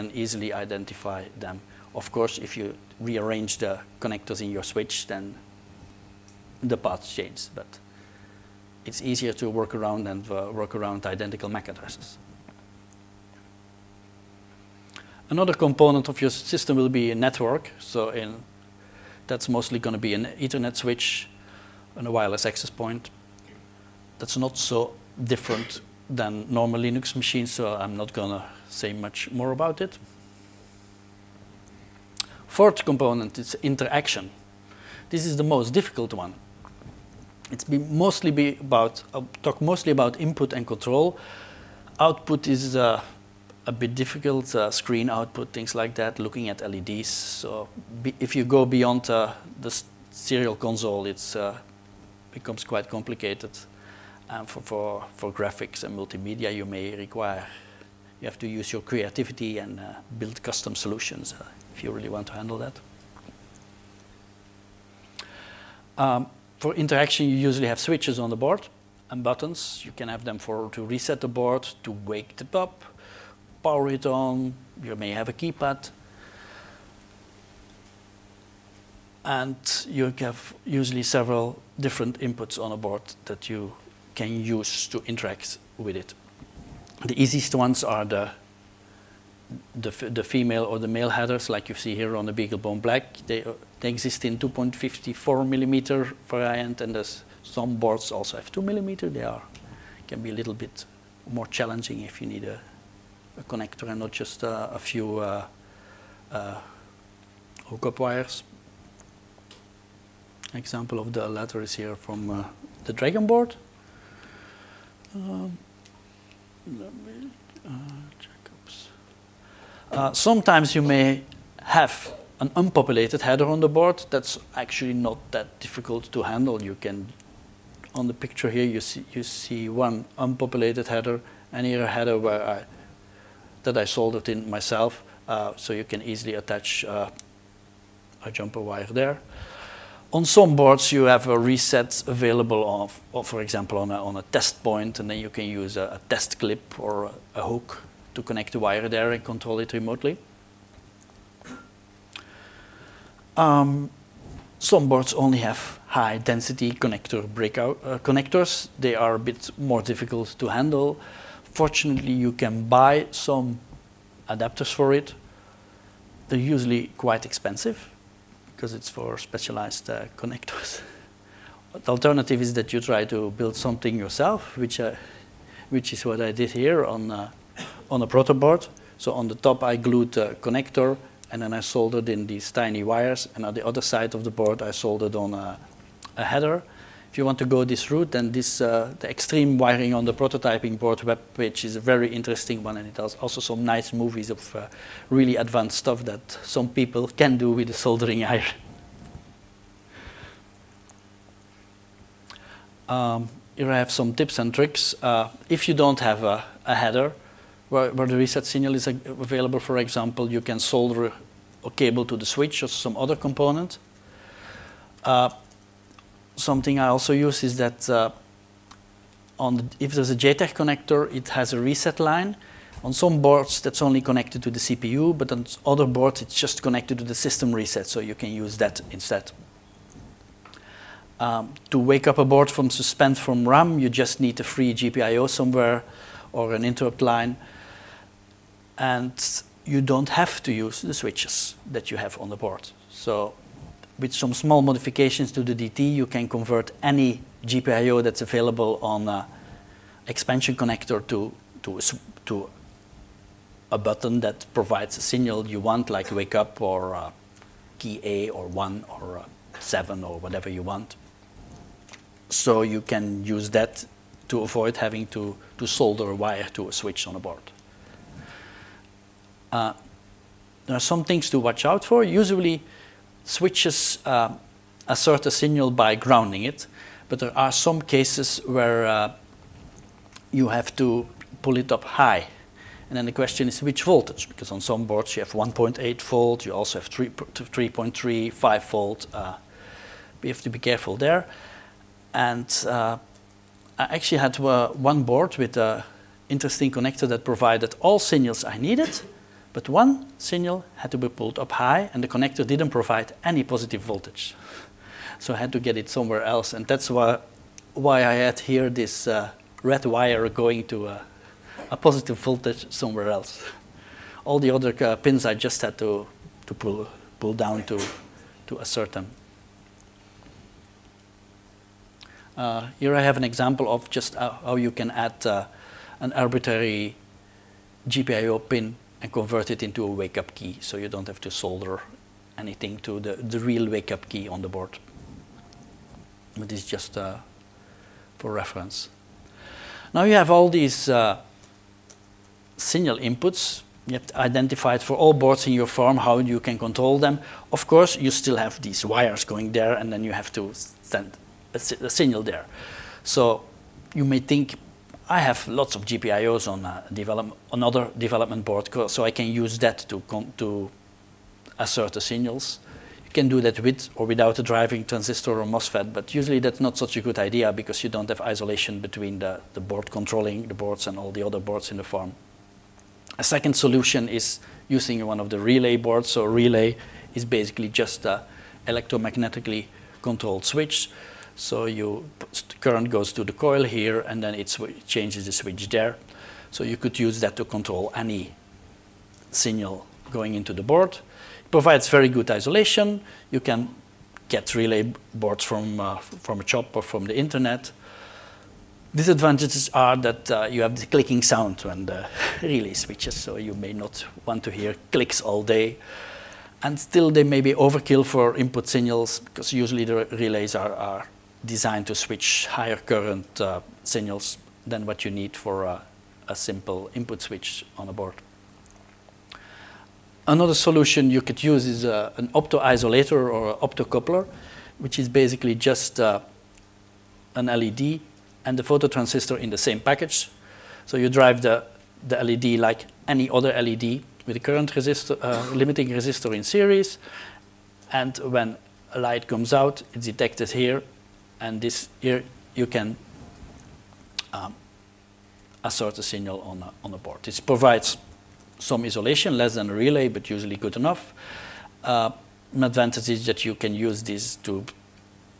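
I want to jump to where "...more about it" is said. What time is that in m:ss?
0:29.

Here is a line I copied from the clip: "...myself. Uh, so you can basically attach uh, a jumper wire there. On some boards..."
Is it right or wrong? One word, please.
wrong.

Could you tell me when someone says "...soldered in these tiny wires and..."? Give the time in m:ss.
3:01.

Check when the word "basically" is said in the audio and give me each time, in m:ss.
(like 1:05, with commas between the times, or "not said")
6:17, 7:05.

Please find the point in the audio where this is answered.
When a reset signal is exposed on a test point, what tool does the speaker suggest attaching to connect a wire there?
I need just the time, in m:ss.
2:26.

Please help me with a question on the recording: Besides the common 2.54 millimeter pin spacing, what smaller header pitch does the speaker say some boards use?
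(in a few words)
2 millimeter.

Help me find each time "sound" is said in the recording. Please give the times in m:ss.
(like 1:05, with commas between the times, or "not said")
6:41.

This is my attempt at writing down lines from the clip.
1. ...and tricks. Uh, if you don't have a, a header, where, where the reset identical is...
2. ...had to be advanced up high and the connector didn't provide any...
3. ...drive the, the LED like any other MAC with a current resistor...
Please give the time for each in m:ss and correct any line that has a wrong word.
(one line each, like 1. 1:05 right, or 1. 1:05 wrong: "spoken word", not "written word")
1. 3:24 wrong: "signal", not "identical"
2. 5:00 wrong: "pulled", not "advanced"
3. 7:11 wrong: "LED", not "MAC".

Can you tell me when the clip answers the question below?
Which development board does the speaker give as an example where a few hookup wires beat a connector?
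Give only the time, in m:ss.
1:52.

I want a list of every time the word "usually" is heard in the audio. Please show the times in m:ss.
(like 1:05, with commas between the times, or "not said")
1:07, 1:20, 2:46, 4:32, 6:06, 6:49, 7:30.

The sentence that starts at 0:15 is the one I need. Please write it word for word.
Another component of your system will be a network.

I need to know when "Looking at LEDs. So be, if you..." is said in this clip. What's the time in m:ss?
0:46.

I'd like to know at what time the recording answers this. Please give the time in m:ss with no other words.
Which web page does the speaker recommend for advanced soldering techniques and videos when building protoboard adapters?
3:09.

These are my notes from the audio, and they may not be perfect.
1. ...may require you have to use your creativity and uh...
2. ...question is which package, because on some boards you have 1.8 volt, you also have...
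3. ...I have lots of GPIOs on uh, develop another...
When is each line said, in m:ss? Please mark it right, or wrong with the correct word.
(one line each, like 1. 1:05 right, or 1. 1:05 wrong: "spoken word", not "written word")
1. 0:56 right
2. 4:43 wrong: "voltage", not "package"
3. 5:55 right.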